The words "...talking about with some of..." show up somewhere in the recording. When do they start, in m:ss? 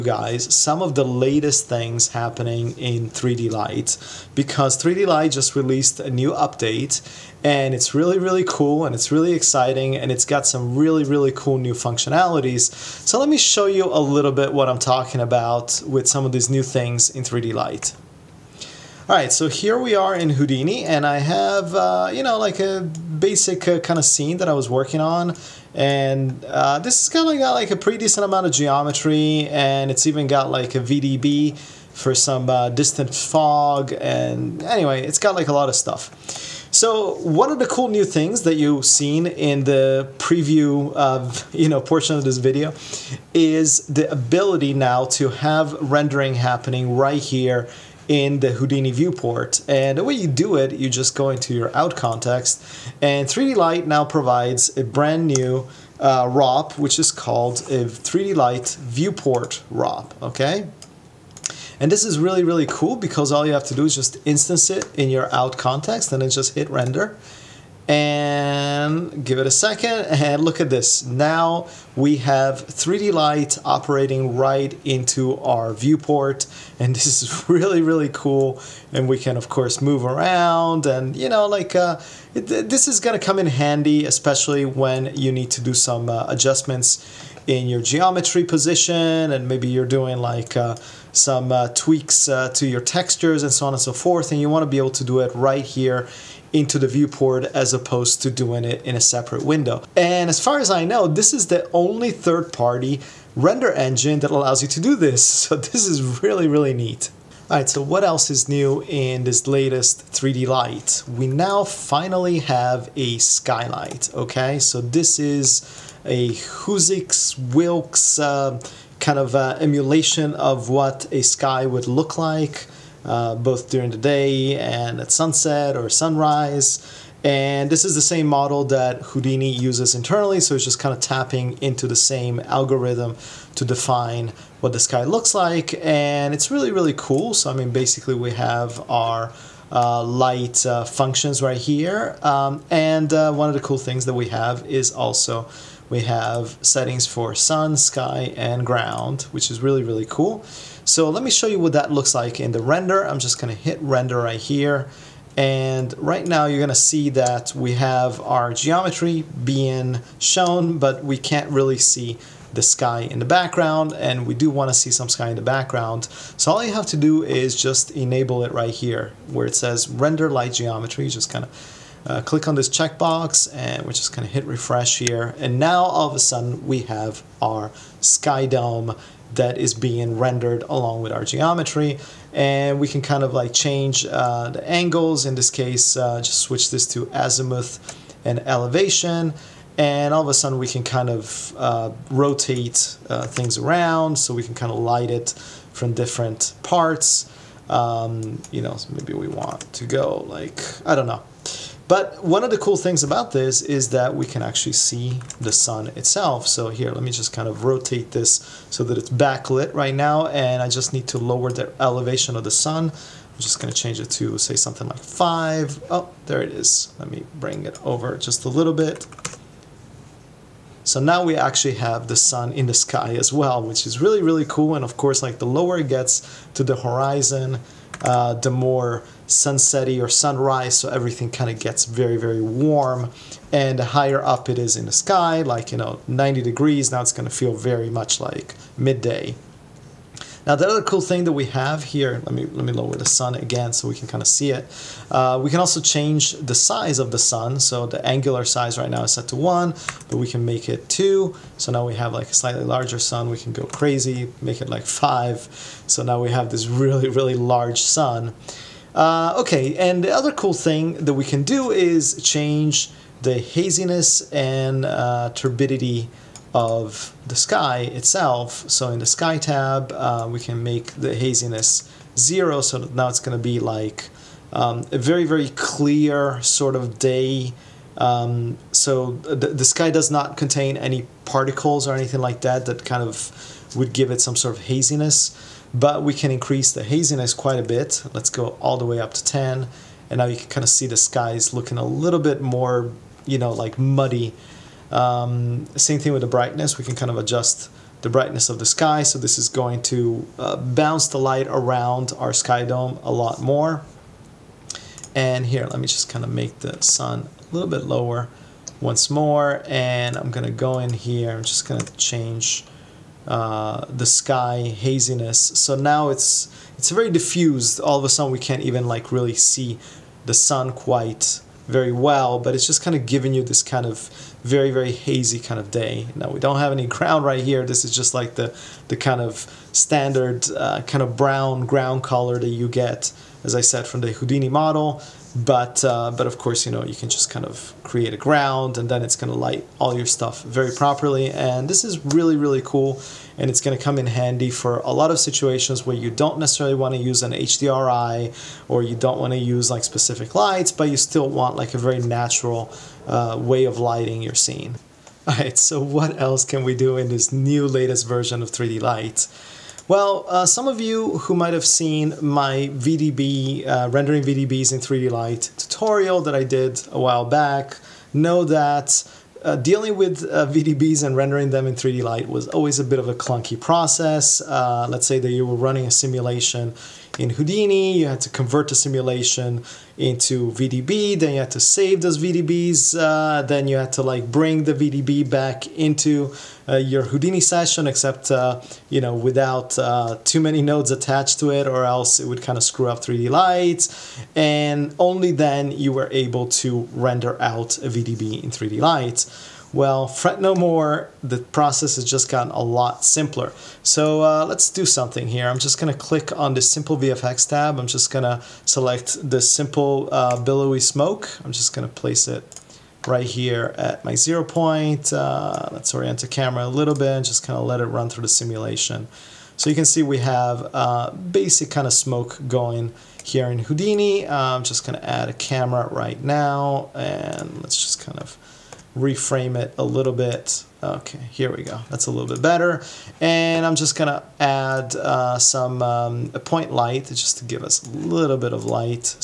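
0:14.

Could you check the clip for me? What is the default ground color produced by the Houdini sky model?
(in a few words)
Brown.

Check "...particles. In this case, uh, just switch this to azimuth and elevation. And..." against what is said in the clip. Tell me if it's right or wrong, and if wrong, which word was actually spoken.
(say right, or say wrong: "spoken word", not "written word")
wrong: "angles", not "particles".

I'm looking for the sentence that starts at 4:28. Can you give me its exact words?
So in the sky tab, uh, we can make the haziness zero.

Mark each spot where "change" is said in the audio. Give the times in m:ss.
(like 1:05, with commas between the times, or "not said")
3:03, 3:33, 4:05, 4:22, 5:11.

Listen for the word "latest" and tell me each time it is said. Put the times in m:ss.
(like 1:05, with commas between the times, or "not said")
0:01, 1:49, 5:57.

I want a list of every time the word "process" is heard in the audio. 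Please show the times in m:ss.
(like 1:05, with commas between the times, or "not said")
6:13, 6:41.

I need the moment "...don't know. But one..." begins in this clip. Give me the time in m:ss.
3:20.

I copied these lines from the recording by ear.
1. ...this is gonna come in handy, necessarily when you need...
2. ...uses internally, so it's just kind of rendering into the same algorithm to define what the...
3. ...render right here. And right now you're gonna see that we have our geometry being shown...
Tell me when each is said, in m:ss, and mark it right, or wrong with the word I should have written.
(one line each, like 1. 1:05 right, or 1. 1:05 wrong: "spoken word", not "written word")
1. 1:22 wrong: "especially", not "necessarily"
2. 2:09 wrong: "tapping", not "rendering"
3. 2:33 right.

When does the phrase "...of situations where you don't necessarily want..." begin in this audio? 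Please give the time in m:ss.
5:45.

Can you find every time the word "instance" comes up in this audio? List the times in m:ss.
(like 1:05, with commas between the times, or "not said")
1:04.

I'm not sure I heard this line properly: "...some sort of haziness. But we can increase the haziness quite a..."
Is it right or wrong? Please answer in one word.
right.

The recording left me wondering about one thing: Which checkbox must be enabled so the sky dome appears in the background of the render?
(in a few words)
Render light geometry.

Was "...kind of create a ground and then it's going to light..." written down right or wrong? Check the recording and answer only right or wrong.
right.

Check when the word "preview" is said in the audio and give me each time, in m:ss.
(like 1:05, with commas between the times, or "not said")
0:40.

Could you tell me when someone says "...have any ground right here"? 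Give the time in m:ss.
5:26.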